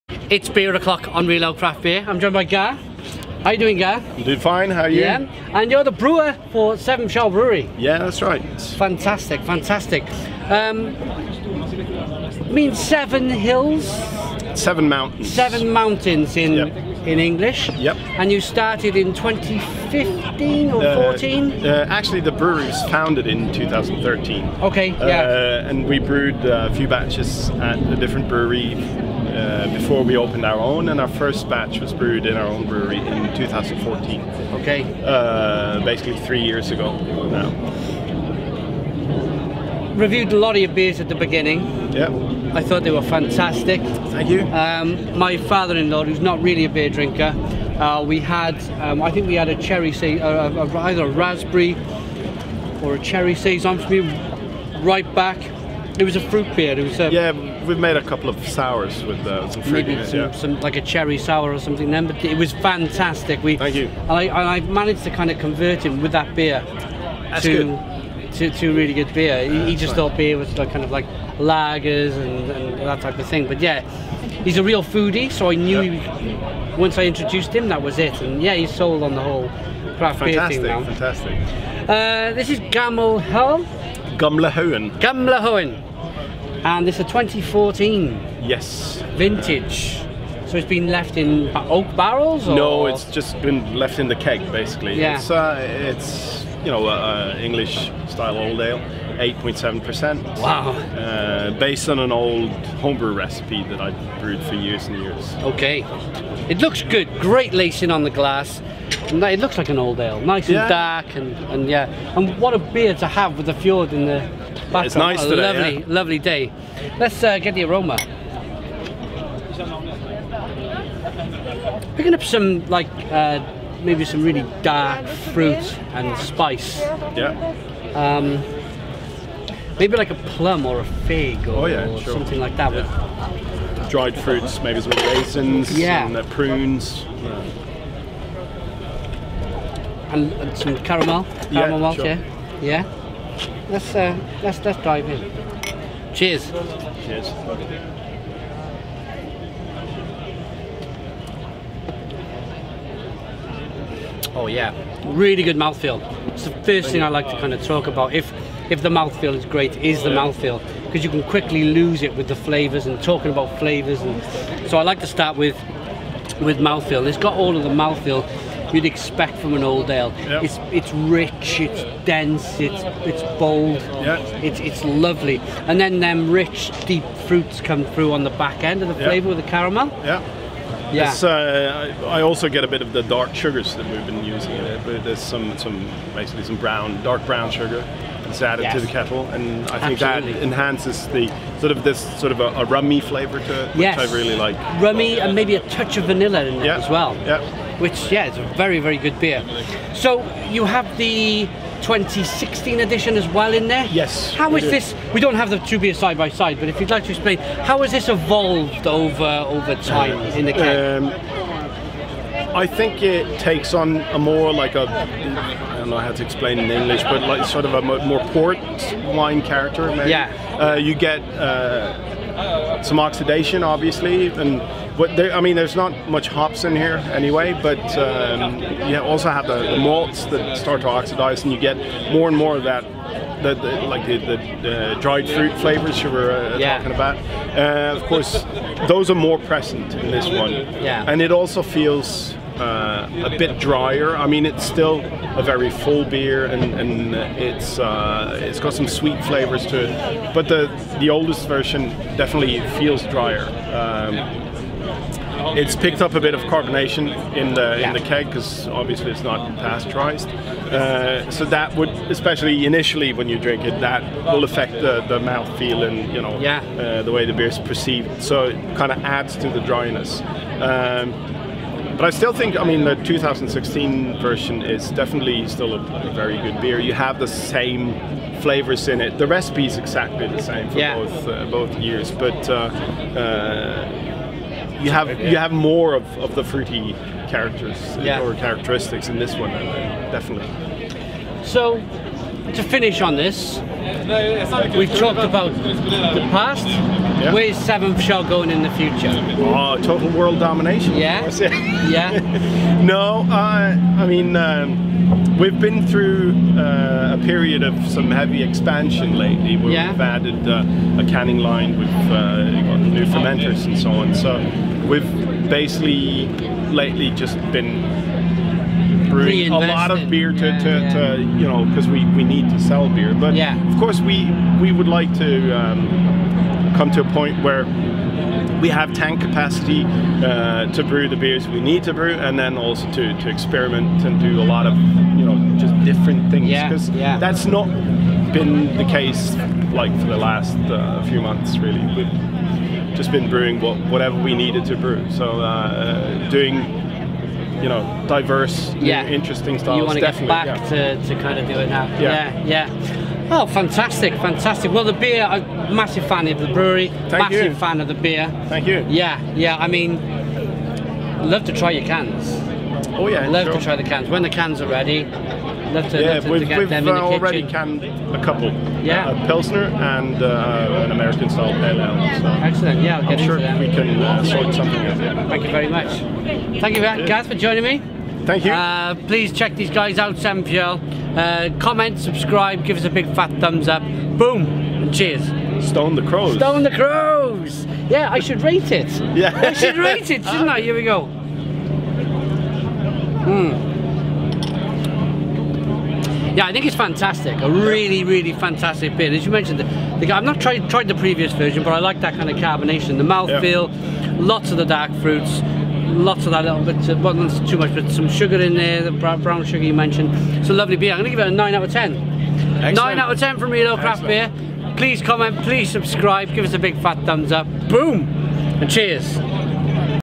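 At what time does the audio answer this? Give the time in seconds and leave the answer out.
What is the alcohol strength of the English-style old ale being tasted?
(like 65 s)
99 s.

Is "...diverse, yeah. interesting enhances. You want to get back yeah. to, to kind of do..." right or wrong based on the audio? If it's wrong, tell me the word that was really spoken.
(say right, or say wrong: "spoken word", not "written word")
wrong: "styles", not "enhances".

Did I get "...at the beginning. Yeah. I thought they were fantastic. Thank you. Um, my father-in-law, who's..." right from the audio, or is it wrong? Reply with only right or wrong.
right.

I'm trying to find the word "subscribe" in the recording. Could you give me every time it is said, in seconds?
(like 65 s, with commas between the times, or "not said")
381 s, 415 s.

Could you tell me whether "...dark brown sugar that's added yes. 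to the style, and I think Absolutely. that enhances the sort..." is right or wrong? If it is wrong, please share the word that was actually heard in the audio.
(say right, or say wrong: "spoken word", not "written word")
wrong: "kettle", not "style".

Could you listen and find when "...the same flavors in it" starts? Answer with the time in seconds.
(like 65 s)
277 s.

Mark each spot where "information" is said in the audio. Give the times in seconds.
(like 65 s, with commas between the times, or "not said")
not said.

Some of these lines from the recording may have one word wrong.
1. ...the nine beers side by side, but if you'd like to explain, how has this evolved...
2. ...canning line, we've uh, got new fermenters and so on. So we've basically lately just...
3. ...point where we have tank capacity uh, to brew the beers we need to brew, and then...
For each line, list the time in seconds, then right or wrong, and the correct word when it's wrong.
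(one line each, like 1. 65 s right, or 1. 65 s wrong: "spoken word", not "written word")
1. 205 s wrong: "two", not "nine"
2. 311 s right
3. 327 s right.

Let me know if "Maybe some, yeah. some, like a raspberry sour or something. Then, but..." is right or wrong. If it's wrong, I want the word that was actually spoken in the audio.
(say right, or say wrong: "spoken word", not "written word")
wrong: "cherry", not "raspberry".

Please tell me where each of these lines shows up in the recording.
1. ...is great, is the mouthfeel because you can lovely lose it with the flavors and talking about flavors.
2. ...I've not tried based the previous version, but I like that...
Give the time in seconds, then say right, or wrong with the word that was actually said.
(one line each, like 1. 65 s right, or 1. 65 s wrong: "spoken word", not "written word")
1. 159 s wrong: "quickly", not "lovely"
2. 400 s wrong: "tried", not "based".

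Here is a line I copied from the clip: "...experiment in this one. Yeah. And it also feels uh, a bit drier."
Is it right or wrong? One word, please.
wrong.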